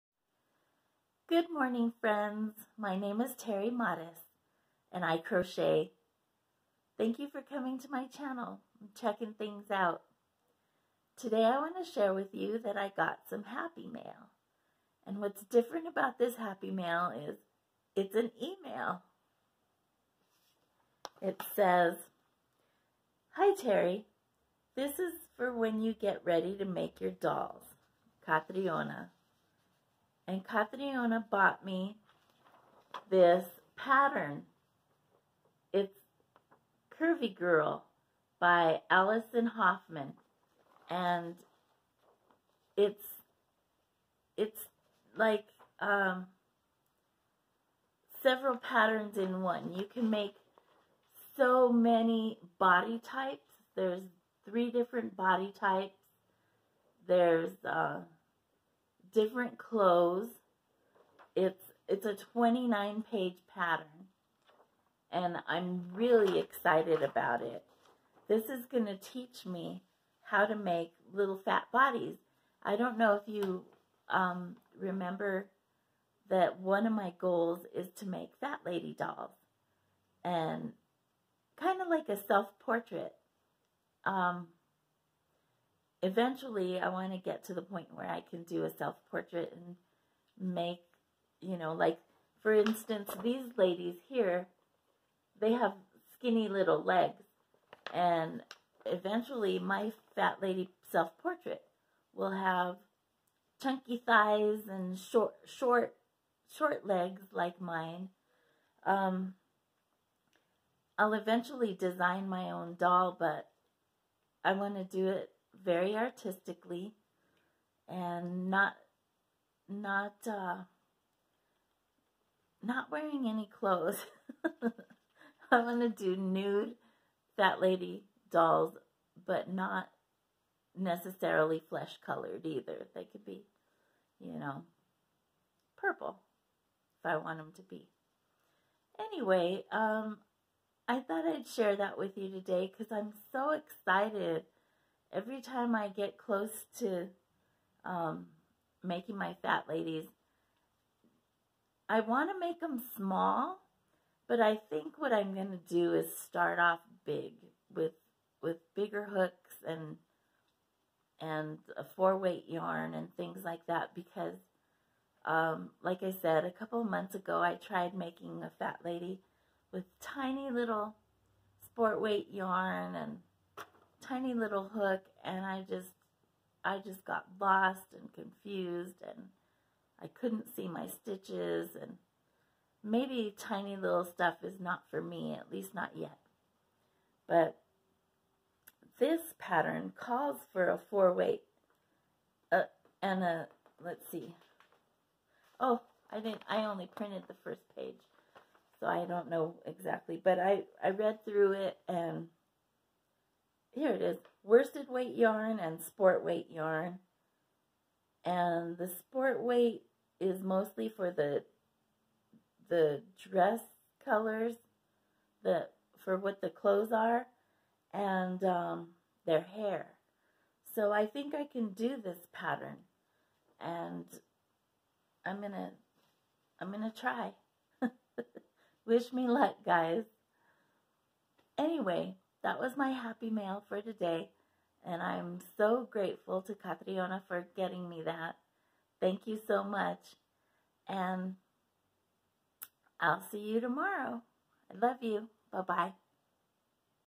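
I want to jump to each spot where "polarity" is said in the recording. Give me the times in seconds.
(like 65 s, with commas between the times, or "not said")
not said.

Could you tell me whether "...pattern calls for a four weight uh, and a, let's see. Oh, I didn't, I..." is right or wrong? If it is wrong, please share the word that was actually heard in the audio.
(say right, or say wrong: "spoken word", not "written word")
right.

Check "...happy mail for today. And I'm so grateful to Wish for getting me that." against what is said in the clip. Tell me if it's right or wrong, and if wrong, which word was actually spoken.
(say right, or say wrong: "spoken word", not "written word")
wrong: "Catriona", not "Wish".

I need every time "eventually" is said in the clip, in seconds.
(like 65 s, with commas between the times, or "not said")
86 s, 98 s, 111 s.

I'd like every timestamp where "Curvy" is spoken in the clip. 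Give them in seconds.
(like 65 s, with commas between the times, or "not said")
36 s.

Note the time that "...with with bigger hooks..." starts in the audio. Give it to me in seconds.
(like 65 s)
157 s.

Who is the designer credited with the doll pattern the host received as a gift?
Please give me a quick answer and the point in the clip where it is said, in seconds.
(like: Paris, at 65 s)
Allison Hoffman, at 38 s.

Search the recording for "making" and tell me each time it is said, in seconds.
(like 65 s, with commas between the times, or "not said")
148 s, 167 s.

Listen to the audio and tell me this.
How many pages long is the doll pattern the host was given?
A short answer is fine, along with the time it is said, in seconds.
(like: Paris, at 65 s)
29, at 62 s.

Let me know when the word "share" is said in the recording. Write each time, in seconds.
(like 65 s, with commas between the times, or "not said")
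11 s, 141 s.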